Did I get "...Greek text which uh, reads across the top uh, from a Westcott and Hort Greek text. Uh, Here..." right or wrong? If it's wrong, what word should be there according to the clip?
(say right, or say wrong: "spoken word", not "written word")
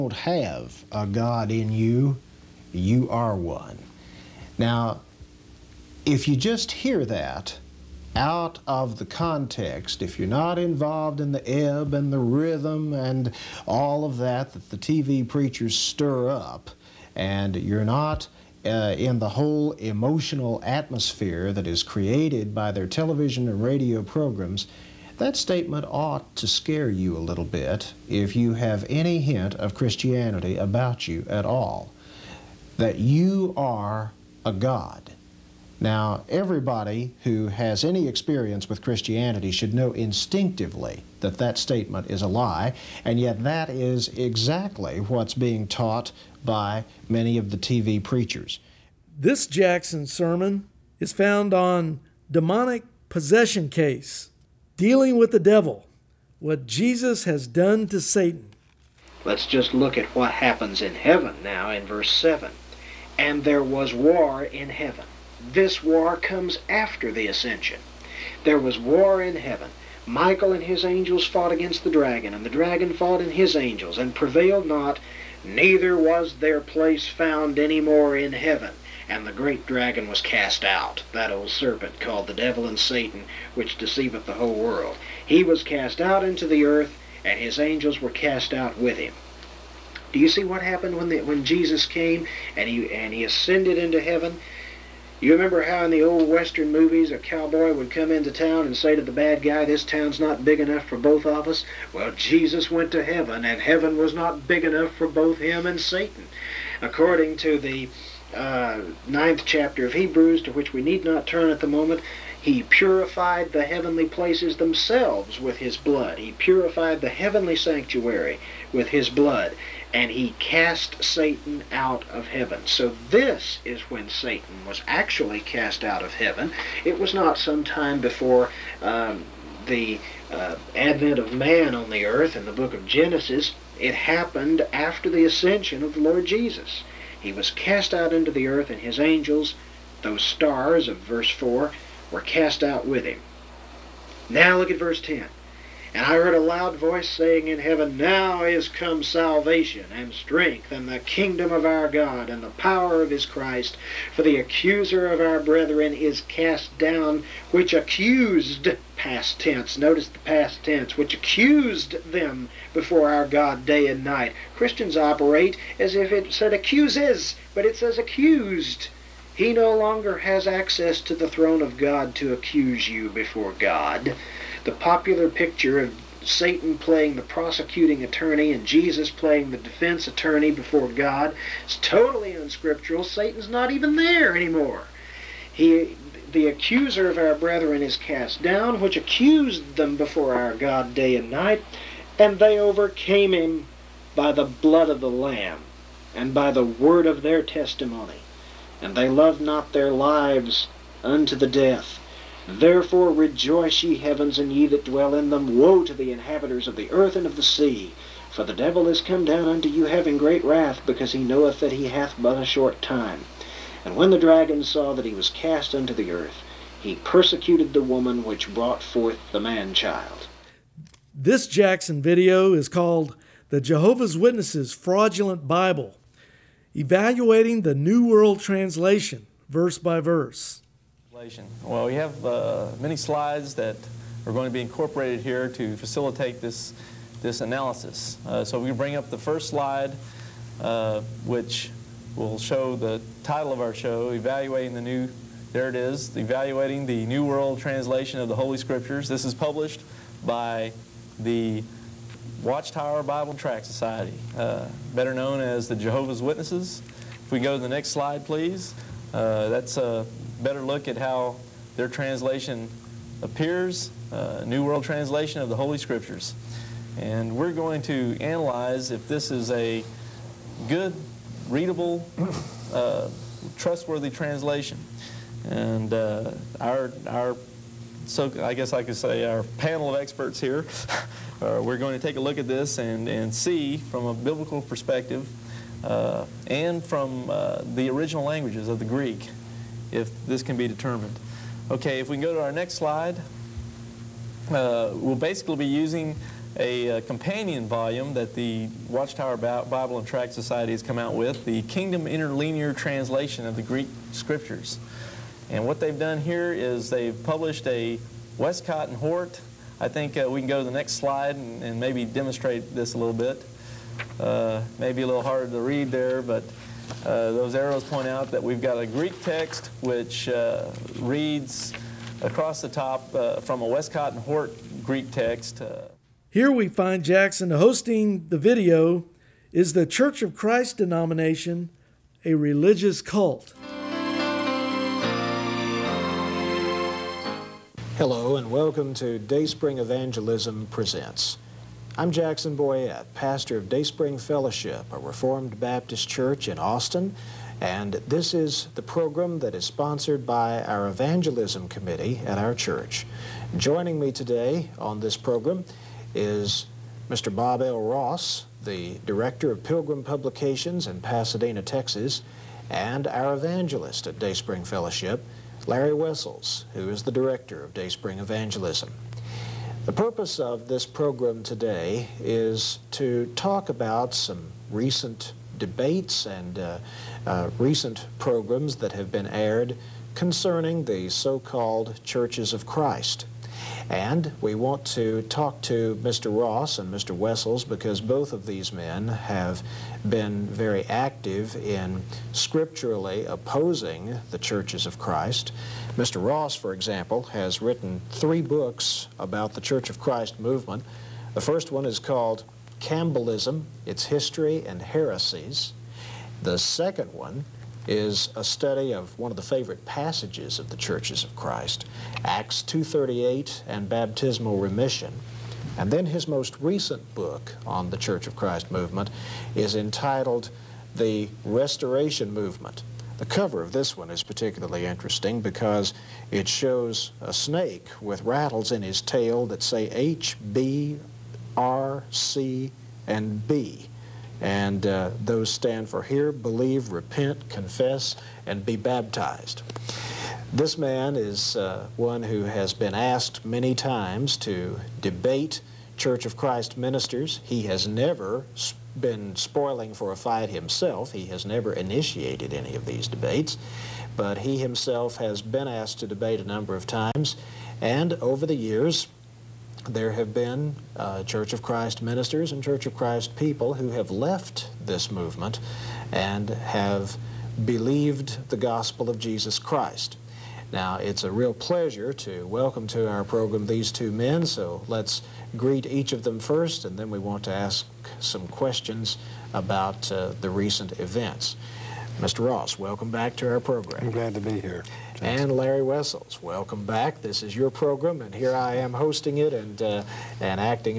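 right.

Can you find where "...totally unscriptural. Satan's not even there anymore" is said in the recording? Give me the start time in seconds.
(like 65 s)
181 s.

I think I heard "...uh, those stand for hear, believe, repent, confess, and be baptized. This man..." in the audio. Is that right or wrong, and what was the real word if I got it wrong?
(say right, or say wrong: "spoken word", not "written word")
right.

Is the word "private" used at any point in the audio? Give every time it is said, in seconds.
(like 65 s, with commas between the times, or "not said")
not said.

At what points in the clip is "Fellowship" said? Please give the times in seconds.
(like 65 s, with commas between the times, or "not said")
344 s, 364 s.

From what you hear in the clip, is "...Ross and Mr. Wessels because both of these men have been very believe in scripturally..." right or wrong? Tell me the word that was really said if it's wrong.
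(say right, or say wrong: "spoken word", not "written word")
wrong: "active", not "believe".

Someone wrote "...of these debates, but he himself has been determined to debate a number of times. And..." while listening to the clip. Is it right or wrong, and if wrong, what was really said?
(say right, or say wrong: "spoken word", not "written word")
wrong: "asked", not "determined".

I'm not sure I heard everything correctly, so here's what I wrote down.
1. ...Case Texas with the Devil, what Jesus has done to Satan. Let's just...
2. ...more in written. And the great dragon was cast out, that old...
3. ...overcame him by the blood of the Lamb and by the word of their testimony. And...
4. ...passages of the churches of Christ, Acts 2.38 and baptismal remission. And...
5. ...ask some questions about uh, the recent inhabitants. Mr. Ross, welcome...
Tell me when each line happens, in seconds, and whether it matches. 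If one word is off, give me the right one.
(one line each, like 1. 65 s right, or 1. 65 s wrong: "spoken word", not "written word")
1. 53 s wrong: "Dealing", not "Texas"
2. 77 s wrong: "heaven", not "written"
3. 192 s right
4. 409 s right
5. 477 s wrong: "events", not "inhabitants".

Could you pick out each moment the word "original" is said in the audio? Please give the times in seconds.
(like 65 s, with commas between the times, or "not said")
287 s.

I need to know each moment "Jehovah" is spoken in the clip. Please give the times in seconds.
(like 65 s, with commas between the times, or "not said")
223 s, 255 s.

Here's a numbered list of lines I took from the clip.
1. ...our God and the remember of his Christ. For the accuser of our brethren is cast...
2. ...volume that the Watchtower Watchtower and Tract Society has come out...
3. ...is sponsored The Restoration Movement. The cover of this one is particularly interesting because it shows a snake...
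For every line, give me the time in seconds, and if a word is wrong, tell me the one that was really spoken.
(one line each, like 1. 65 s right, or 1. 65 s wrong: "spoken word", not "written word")
1. 151 s wrong: "power", not "remember"
2. 297 s wrong: "Bible", not "Watchtower"
3. 419 s wrong: "entitled", not "sponsored".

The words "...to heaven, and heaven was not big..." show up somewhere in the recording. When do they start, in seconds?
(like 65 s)
102 s.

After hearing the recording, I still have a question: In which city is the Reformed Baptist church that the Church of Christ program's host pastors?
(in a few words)
Austin.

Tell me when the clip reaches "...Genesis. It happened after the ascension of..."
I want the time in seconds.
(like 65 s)
132 s.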